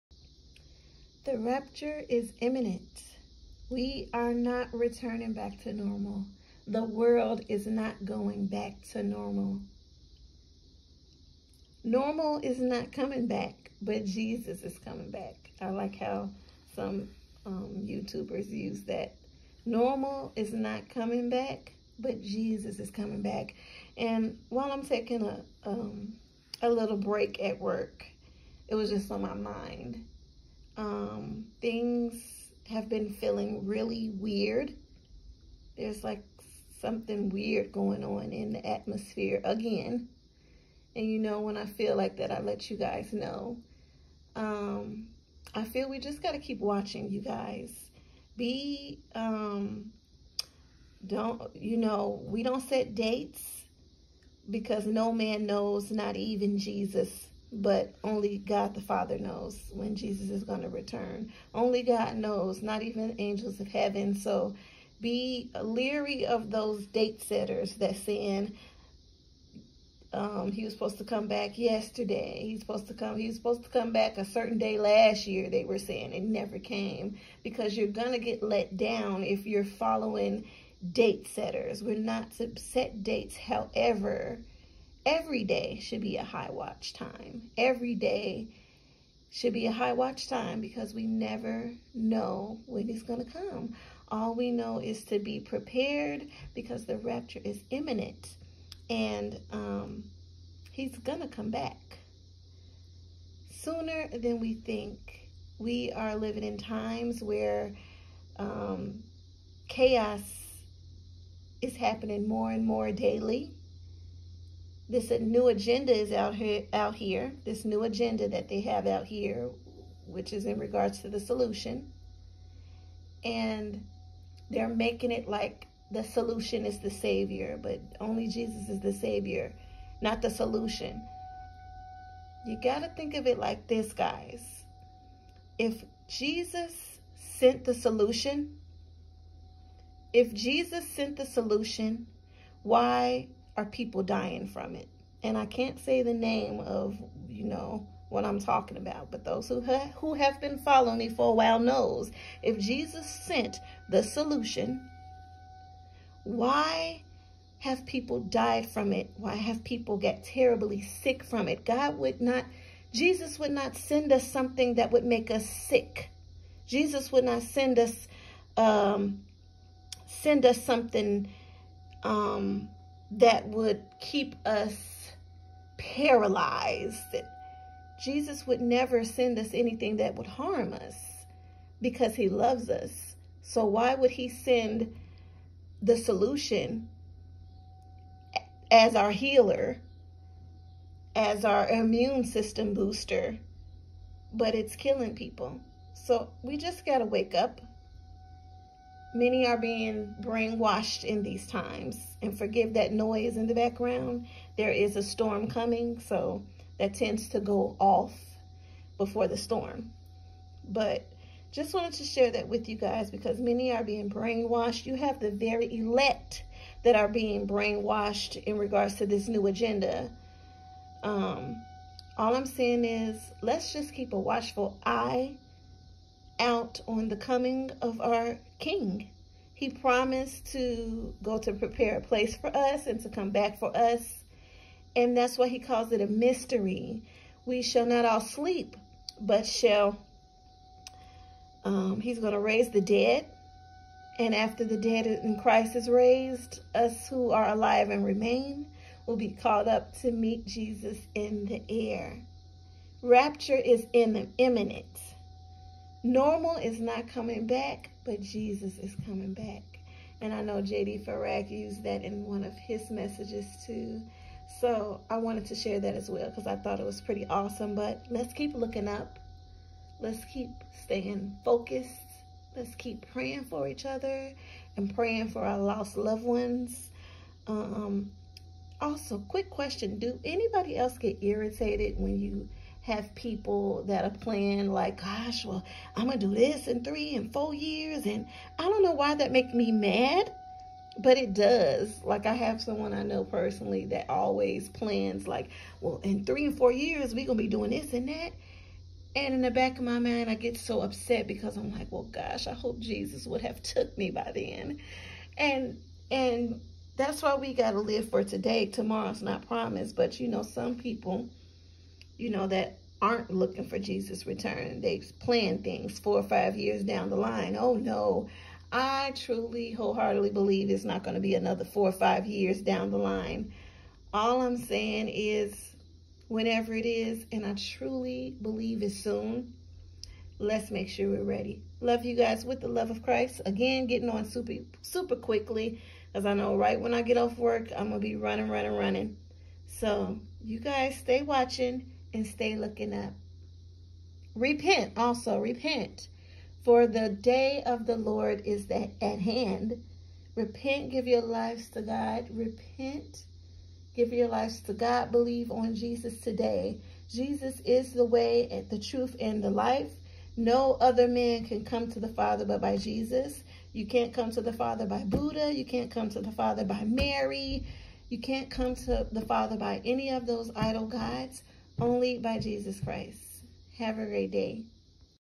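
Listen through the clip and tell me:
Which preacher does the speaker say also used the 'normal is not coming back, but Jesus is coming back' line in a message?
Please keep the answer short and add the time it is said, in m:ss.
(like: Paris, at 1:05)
J.D. Farag, at 4:20.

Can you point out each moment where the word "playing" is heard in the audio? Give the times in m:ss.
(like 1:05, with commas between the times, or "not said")
4:44.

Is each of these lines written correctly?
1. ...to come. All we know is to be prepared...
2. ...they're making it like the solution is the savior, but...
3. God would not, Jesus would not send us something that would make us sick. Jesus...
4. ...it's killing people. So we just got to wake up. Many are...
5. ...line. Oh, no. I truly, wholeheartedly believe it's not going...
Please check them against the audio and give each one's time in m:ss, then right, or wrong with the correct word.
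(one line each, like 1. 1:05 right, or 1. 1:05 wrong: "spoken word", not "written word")
1. 1:33 right
2. 2:04 right
3. 2:41 right
4. 3:14 right
5. 5:17 right.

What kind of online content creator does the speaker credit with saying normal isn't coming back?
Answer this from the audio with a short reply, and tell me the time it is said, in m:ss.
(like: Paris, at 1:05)
YouTubers, at 0:17.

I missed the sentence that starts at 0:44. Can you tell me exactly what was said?
Um, I feel we just got to keep watching, you guys.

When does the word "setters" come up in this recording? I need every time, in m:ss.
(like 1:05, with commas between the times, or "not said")
1:07, 1:21.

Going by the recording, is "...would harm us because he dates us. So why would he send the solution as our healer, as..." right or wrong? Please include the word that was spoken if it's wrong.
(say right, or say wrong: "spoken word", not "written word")
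wrong: "loves", not "dates".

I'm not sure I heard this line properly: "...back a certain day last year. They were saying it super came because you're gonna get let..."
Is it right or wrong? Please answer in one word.
wrong.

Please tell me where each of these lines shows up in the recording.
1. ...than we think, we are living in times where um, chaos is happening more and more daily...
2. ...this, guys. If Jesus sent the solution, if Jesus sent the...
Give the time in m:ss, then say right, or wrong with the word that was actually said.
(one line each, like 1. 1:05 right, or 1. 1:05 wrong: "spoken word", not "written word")
1. 1:44 right
2. 2:13 right.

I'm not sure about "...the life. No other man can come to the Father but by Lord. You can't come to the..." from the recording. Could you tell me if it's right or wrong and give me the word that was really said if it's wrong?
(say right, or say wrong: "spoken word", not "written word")
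wrong: "Jesus", not "Lord".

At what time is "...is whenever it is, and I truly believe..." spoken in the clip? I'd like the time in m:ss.
5:25.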